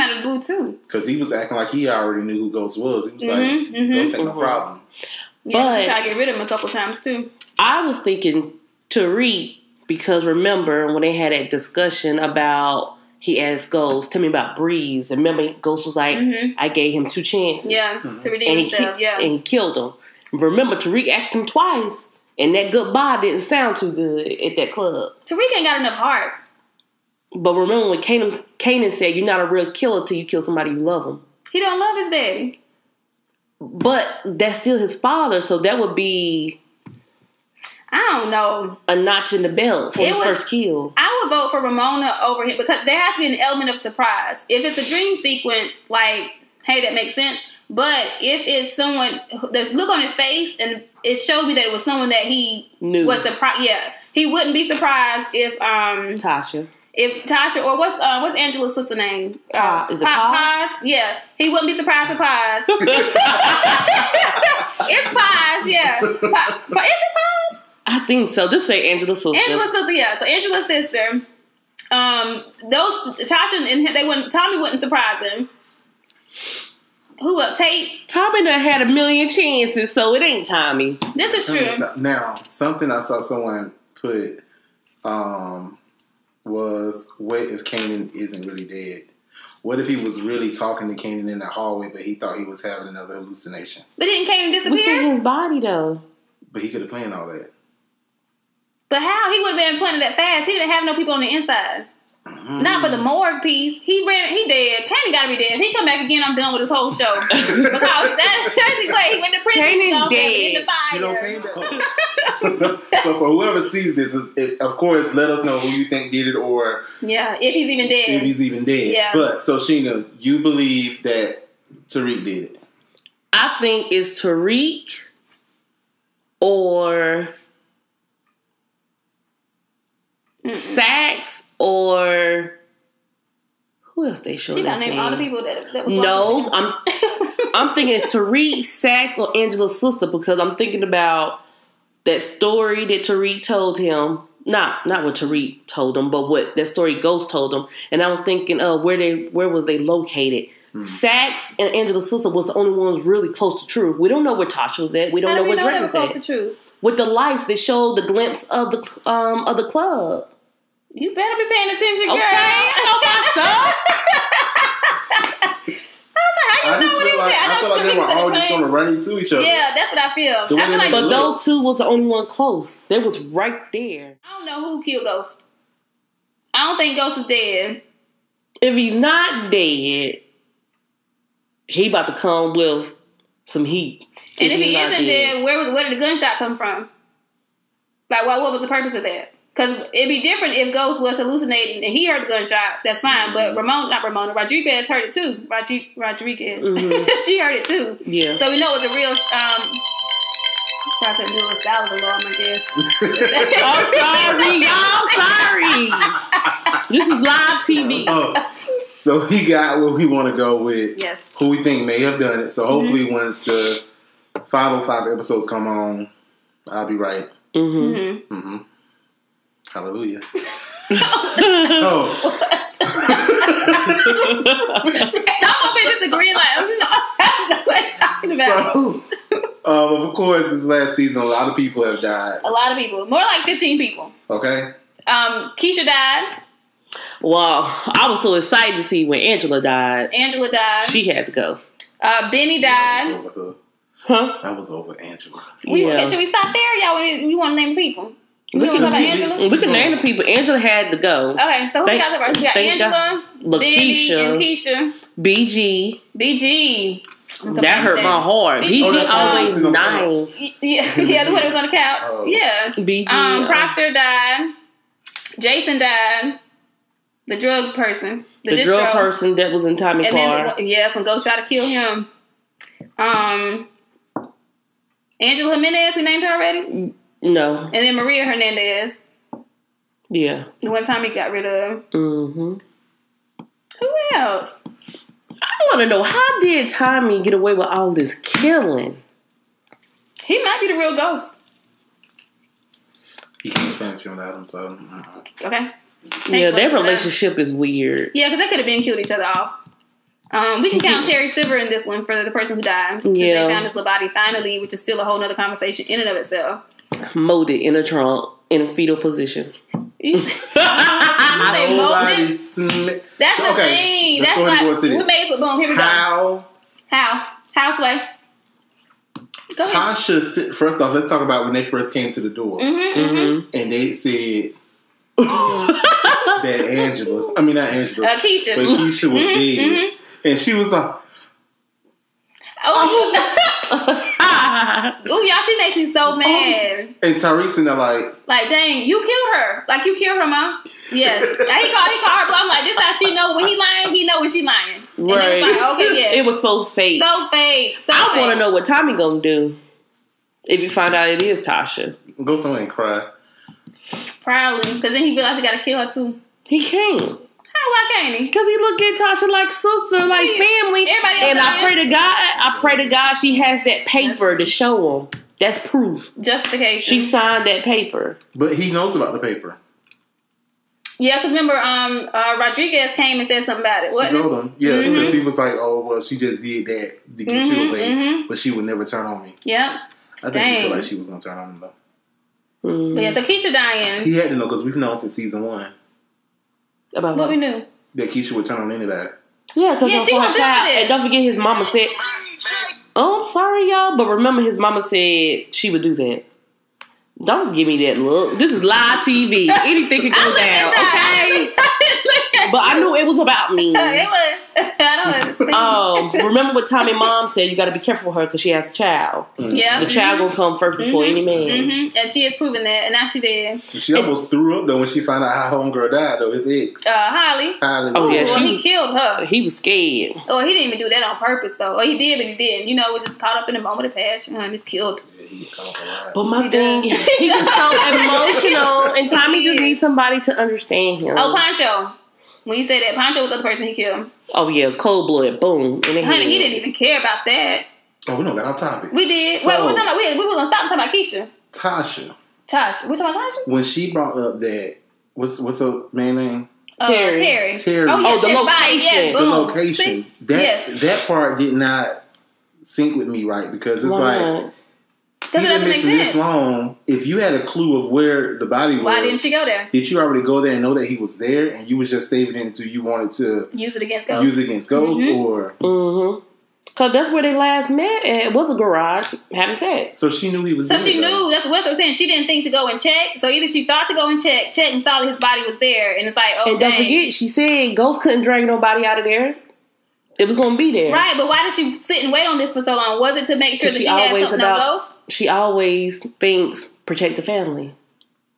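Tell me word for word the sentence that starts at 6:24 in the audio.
He had to know because we've known since season one.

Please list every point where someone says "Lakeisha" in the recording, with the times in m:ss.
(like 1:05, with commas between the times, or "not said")
4:13.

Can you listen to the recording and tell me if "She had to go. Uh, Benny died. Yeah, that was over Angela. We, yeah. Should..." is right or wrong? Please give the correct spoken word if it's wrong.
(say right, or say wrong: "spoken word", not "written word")
right.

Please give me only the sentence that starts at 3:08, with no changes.
Like, well, what was the purpose of that?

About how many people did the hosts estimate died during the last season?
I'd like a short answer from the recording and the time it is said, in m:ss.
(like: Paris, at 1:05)
15, at 3:53.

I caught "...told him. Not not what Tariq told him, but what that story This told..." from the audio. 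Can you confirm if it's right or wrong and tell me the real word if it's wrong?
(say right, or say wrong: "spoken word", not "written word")
wrong: "Ghost", not "This".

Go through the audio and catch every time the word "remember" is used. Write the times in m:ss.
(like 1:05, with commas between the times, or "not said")
0:10, 0:15, 0:20, 0:27, 6:11, 6:34, 6:46.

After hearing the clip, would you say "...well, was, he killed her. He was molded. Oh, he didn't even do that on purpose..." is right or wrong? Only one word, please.
wrong.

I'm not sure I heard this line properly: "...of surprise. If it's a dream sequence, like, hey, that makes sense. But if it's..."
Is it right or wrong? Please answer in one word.
right.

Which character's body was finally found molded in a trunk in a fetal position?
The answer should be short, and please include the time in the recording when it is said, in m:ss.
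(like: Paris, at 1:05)
Terry Silver, at 5:01.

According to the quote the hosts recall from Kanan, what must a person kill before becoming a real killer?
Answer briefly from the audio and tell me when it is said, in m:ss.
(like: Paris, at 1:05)
somebody you love, at 0:30.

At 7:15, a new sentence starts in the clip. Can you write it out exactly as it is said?
Honey, he didn't even care about that.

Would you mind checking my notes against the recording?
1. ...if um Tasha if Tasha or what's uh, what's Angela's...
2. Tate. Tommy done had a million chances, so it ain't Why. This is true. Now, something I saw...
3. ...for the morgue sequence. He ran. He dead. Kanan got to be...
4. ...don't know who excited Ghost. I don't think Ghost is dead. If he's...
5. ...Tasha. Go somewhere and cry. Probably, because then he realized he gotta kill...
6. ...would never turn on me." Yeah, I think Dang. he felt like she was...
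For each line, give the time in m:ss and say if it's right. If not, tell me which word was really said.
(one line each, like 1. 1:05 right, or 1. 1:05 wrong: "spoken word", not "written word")
1. 0:55 right
2. 1:17 wrong: "Tommy", not "Why"
3. 1:42 wrong: "piece", not "sequence"
4. 2:54 wrong: "killed", not "excited"
5. 5:51 right
6. 6:18 right.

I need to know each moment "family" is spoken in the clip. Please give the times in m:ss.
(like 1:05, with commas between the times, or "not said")
6:00, 8:07.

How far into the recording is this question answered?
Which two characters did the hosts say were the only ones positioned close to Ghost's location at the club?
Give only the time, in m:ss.
2:30.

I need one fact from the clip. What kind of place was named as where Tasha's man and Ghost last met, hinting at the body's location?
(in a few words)
a garage.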